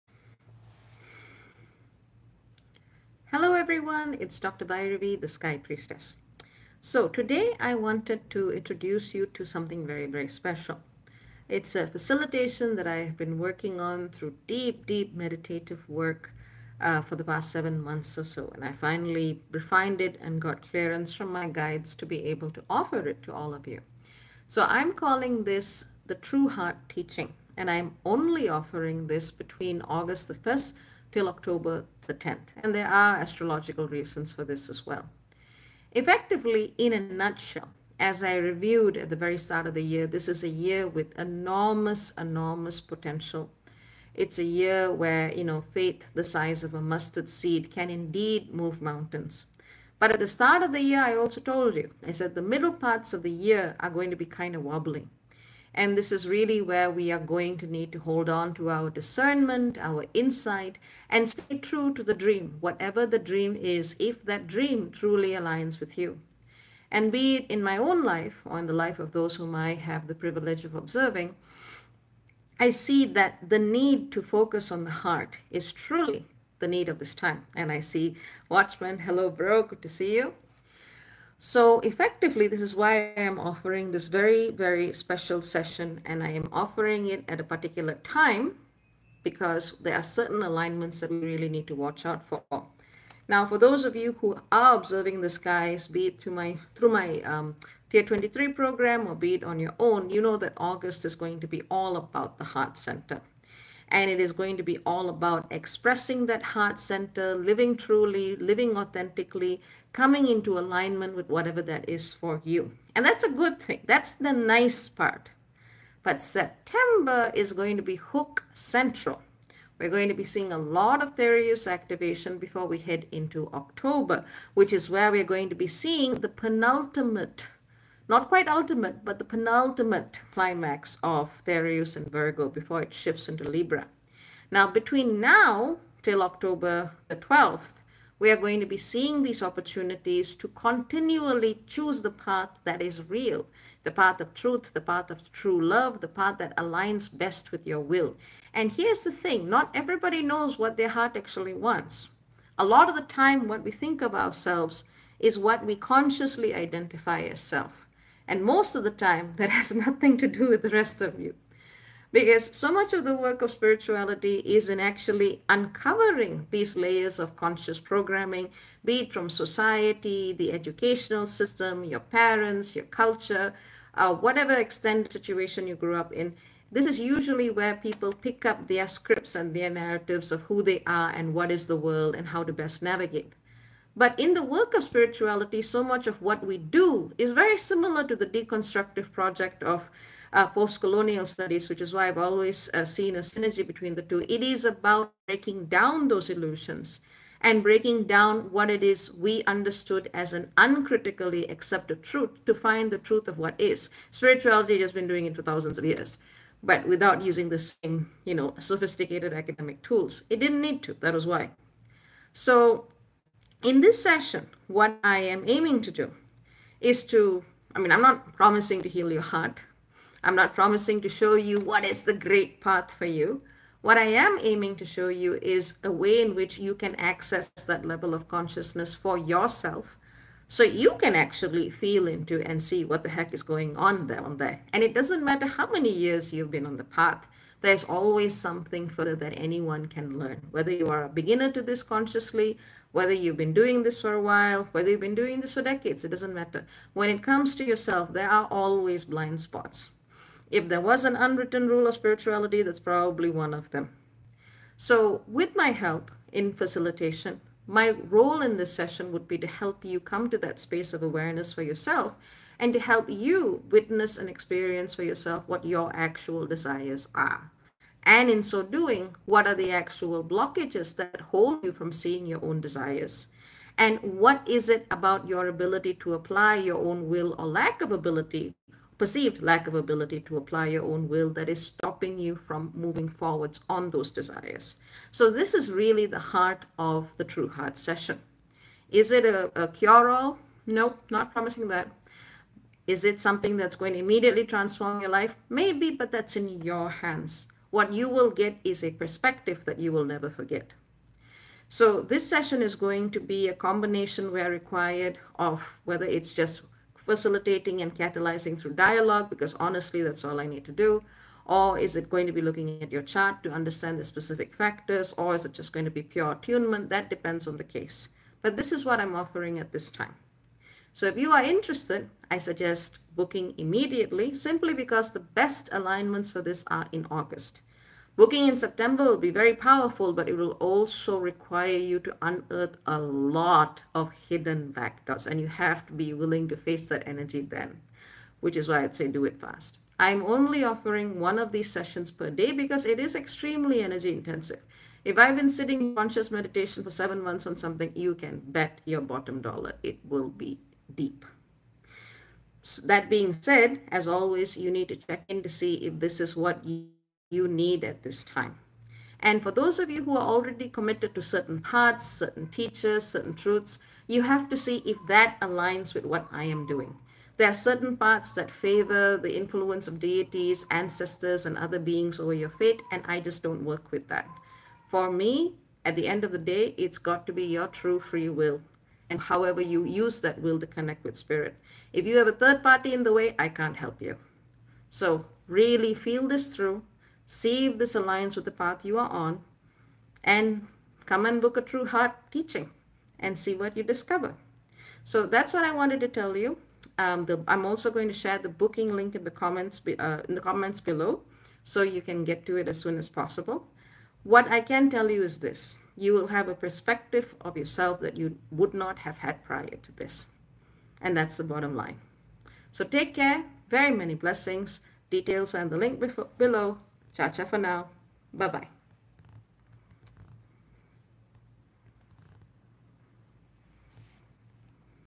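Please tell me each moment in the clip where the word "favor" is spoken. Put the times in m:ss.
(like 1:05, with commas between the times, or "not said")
6:08.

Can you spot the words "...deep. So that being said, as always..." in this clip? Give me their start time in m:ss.
5:50.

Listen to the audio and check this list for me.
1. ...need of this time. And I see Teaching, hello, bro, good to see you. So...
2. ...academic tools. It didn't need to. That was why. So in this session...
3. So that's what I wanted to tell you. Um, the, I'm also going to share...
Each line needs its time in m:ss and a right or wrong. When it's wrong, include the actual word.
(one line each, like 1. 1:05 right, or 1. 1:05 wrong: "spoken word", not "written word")
1. 1:16 wrong: "Watchman", not "Teaching"
2. 3:29 right
3. 6:35 right.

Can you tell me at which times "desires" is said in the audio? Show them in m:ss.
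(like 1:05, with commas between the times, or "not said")
4:26, 4:32, 4:44.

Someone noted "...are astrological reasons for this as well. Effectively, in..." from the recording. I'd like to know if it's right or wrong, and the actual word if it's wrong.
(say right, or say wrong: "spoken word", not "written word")
right.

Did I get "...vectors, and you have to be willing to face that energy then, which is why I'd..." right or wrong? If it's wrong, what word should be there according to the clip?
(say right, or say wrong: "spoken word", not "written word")
right.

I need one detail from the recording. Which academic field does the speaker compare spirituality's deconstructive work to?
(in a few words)
Post colonial studies.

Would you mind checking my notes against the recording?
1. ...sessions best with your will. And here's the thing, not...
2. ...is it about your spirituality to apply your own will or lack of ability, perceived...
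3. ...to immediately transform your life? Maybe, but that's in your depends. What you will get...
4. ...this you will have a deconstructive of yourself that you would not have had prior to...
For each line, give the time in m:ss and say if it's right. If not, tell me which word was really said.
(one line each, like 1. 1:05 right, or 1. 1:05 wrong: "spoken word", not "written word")
1. 2:26 wrong: "aligns", not "sessions"
2. 4:34 wrong: "ability", not "spirituality"
3. 4:53 wrong: "hands", not "depends"
4. 6:45 wrong: "perspective", not "deconstructive".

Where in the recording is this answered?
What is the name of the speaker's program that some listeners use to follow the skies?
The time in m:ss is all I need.
1:37.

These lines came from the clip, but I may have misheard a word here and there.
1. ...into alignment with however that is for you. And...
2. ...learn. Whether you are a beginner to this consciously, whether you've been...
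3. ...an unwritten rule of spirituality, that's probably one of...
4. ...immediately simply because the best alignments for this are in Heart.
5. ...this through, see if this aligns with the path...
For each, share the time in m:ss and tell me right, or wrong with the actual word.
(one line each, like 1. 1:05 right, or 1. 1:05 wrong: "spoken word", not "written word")
1. 1:50 wrong: "whatever", not "however"
2. 4:00 right
3. 4:11 right
4. 5:23 wrong: "August", not "Heart"
5. 6:26 right.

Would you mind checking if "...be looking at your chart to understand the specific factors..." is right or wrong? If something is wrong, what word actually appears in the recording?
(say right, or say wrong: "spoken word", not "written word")
right.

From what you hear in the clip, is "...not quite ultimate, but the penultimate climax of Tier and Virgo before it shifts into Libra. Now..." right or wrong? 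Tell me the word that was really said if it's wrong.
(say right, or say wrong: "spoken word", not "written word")
wrong: "Therius", not "Tier".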